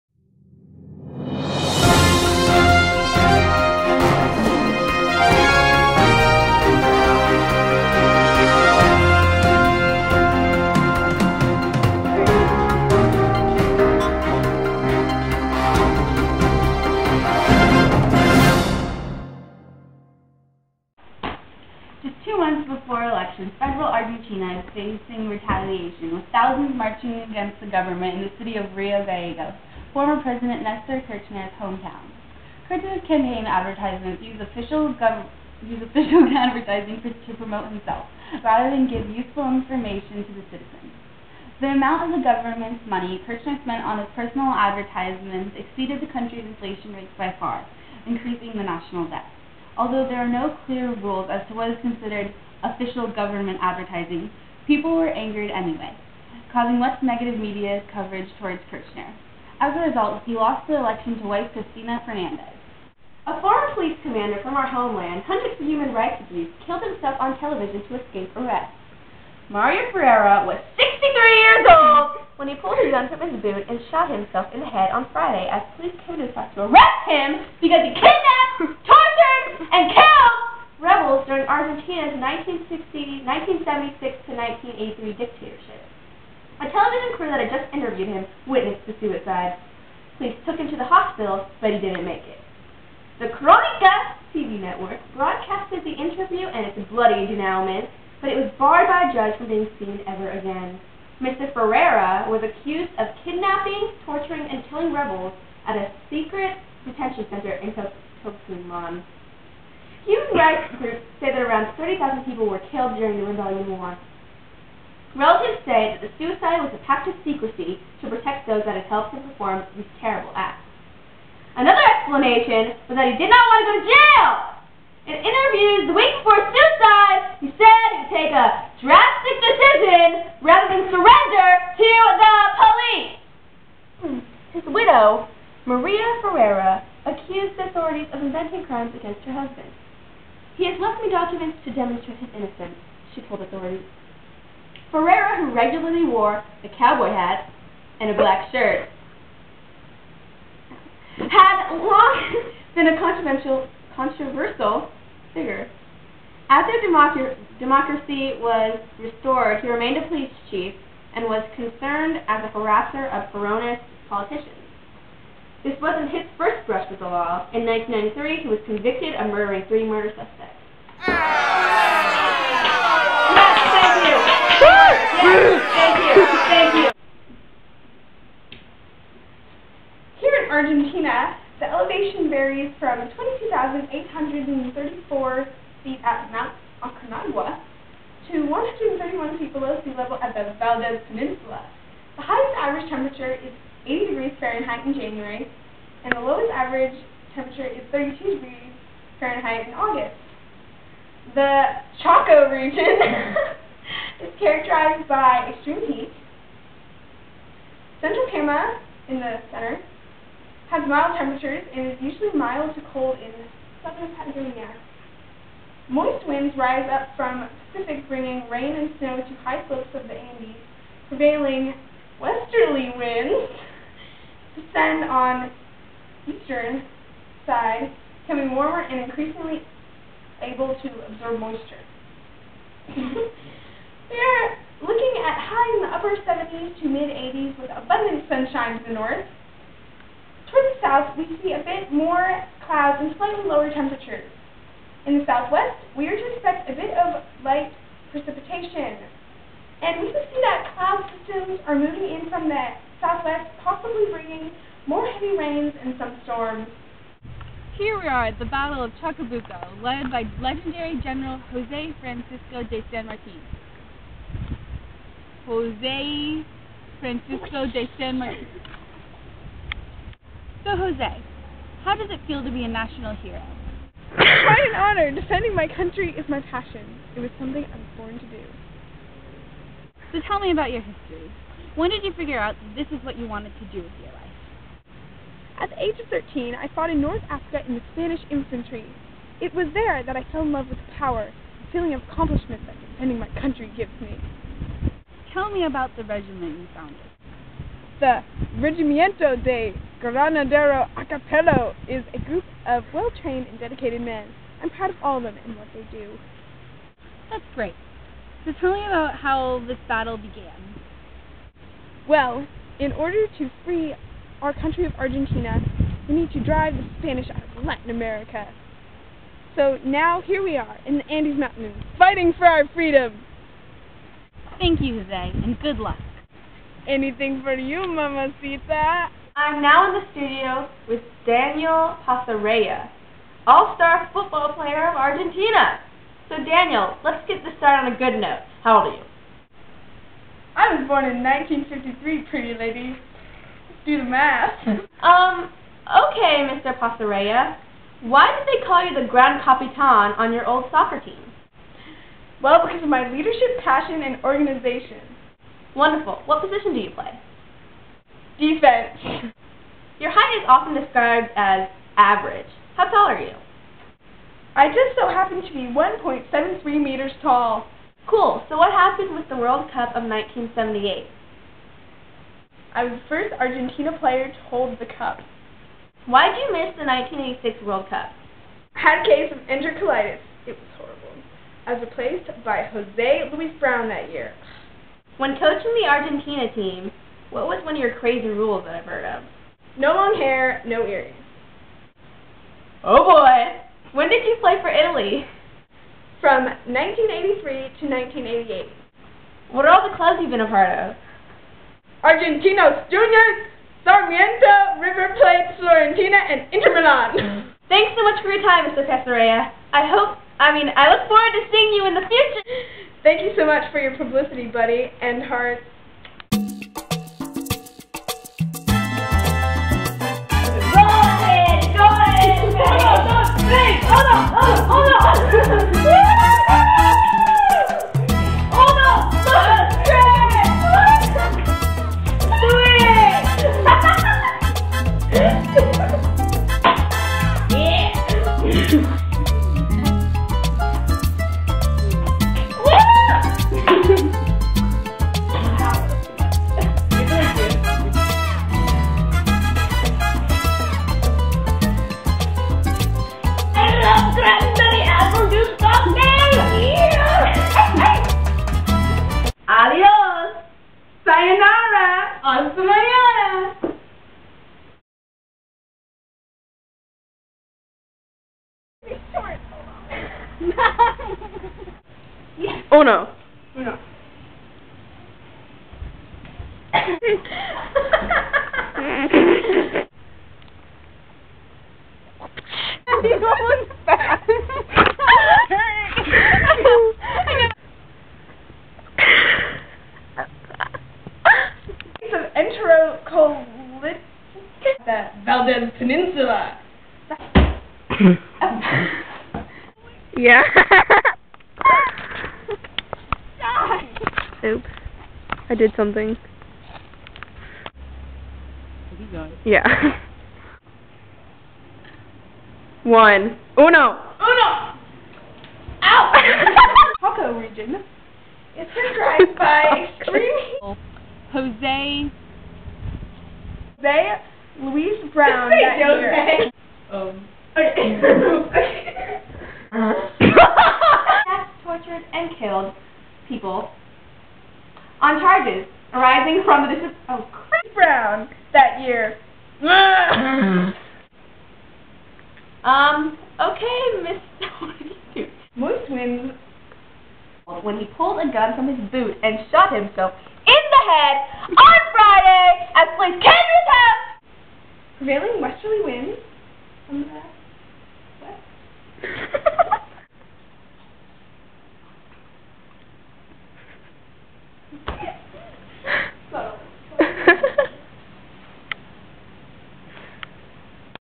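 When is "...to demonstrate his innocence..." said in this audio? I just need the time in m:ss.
2:21.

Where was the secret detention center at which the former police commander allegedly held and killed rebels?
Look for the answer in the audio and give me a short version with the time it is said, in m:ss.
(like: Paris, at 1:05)
Tucumán, at 1:48.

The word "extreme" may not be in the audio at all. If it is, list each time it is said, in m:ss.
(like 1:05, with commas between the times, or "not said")
3:25, 8:39.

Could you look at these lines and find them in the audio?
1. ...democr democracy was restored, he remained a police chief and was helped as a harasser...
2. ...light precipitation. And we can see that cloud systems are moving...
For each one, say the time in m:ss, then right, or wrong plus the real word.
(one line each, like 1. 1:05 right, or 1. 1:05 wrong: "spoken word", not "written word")
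1. 2:36 wrong: "concerned", not "helped"
2. 4:07 right.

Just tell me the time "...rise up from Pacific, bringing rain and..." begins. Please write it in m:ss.
3:36.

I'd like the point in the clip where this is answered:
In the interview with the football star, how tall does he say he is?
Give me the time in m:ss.
6:05.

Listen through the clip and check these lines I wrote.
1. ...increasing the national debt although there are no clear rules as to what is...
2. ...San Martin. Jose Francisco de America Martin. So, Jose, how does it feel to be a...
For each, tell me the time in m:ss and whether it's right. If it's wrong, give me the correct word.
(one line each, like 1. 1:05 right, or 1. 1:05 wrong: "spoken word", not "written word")
1. 0:48 right
2. 4:22 wrong: "San", not "America".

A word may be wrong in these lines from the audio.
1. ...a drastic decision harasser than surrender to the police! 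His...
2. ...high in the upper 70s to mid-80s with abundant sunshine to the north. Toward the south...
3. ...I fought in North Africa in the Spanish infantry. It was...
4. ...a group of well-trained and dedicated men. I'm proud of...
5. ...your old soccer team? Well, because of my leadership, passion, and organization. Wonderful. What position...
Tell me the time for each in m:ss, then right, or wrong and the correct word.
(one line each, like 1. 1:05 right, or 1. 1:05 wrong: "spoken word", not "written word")
1. 2:08 wrong: "rather", not "harasser"
2. 3:55 right
3. 4:46 right
4. 5:02 right
5. 5:50 right.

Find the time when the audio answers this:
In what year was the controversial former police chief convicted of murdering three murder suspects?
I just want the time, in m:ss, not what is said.
2:47.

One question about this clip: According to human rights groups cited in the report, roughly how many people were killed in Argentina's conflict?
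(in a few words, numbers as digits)
30,000.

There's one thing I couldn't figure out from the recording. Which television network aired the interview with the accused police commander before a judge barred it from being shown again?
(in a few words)
Cronica TV.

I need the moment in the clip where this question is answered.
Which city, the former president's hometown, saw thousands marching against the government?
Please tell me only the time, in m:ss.
0:28.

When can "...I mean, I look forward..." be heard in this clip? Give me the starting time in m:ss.
6:50.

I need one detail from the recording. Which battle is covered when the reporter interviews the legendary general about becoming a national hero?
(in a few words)
Battle of Chacabuco.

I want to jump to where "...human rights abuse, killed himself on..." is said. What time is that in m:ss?
1:05.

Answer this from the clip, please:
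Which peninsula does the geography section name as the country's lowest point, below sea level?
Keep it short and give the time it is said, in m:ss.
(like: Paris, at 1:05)
Valdes Peninsula, at 3:10.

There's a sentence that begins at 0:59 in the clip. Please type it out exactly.
As a result, he lost the election to wife Cristina Fernandez.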